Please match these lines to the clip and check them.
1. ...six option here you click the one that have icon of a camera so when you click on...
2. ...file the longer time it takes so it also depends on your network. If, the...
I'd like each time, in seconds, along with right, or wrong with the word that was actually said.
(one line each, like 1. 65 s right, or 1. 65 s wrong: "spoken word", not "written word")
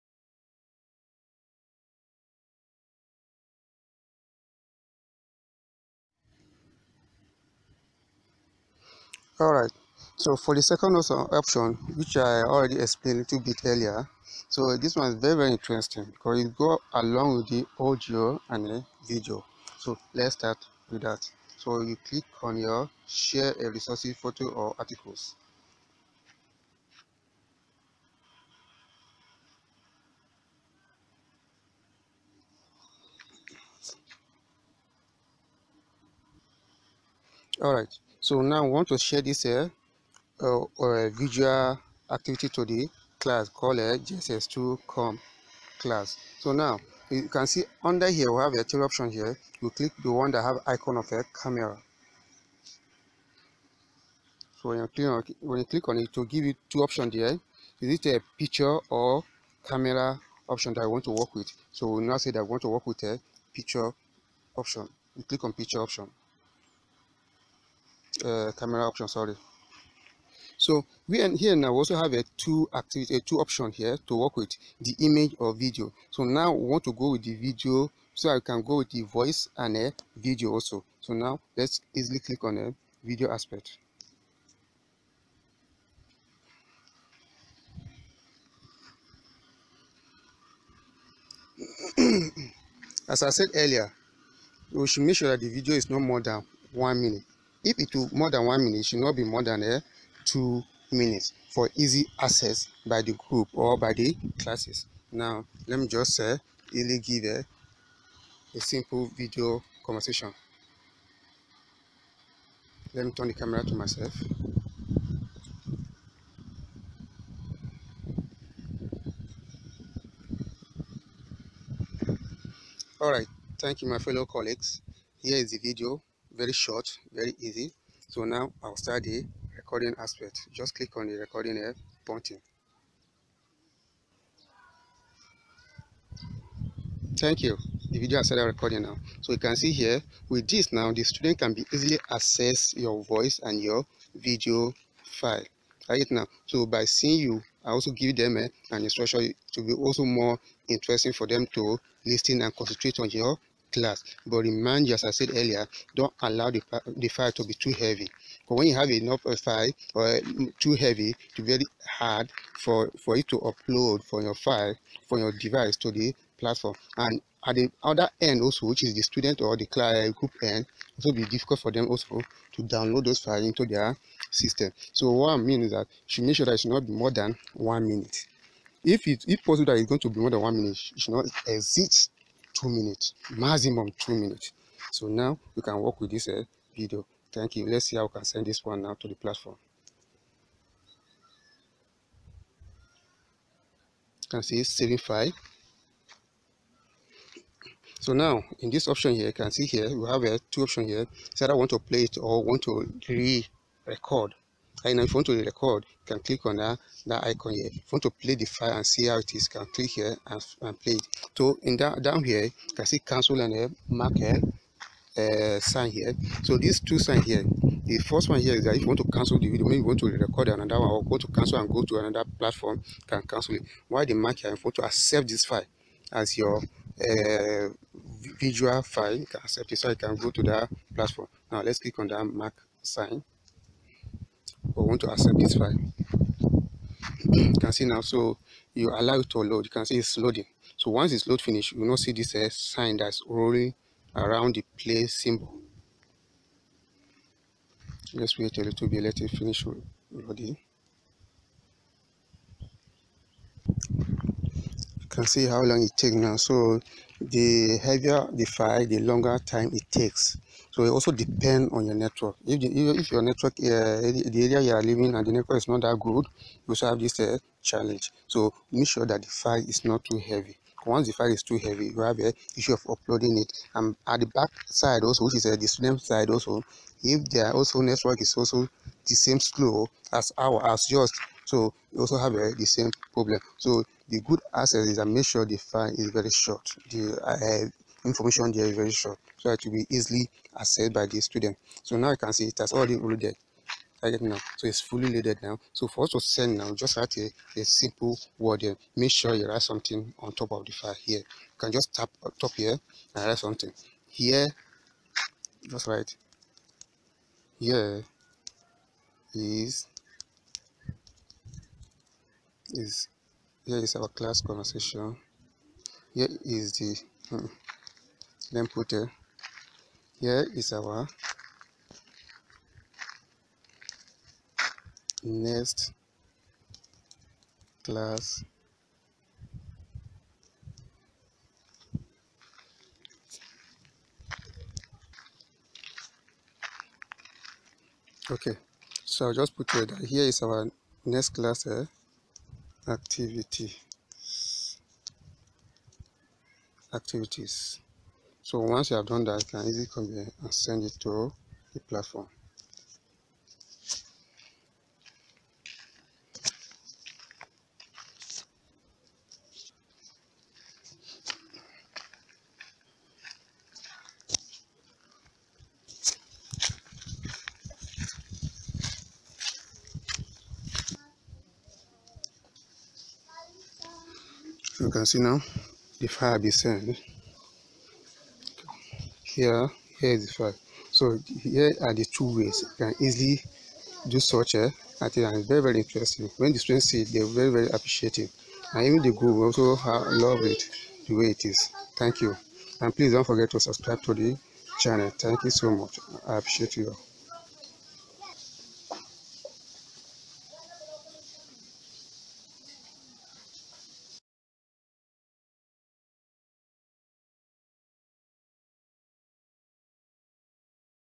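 1. 48 s wrong: "three", not "six"
2. 258 s right.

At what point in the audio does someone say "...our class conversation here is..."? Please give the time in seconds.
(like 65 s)
313 s.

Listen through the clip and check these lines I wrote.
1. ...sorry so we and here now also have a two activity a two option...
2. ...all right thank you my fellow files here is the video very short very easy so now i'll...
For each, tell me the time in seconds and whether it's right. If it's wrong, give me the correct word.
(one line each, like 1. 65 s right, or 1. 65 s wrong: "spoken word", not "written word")
1. 69 s right
2. 122 s wrong: "colleagues", not "files".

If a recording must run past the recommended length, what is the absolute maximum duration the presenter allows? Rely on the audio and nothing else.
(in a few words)
2 minutes.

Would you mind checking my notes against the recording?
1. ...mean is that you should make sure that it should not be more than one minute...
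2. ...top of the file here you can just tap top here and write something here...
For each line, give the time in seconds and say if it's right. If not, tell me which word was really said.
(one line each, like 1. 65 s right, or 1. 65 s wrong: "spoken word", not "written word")
1. 175 s right
2. 300 s right.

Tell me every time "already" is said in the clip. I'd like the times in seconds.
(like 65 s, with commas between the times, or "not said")
12 s, 292 s.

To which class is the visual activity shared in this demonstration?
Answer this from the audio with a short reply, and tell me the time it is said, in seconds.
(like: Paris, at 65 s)
gss2com class, at 43 s.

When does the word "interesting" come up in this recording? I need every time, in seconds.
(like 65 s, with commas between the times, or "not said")
15 s, 150 s, 385 s.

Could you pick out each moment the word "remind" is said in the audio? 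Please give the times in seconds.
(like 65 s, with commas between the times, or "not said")
154 s.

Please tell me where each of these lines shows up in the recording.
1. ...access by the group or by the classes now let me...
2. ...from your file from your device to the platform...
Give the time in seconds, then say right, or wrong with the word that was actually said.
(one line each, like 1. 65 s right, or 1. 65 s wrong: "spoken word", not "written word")
1. 102 s right
2. 164 s right.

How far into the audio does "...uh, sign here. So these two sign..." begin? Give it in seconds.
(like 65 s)
215 s.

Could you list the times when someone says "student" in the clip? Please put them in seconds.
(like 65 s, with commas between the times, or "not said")
141 s, 169 s, 275 s, 291 s, 386 s.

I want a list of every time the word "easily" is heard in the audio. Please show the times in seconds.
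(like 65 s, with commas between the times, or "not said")
81 s, 141 s, 289 s, 349 s, 383 s.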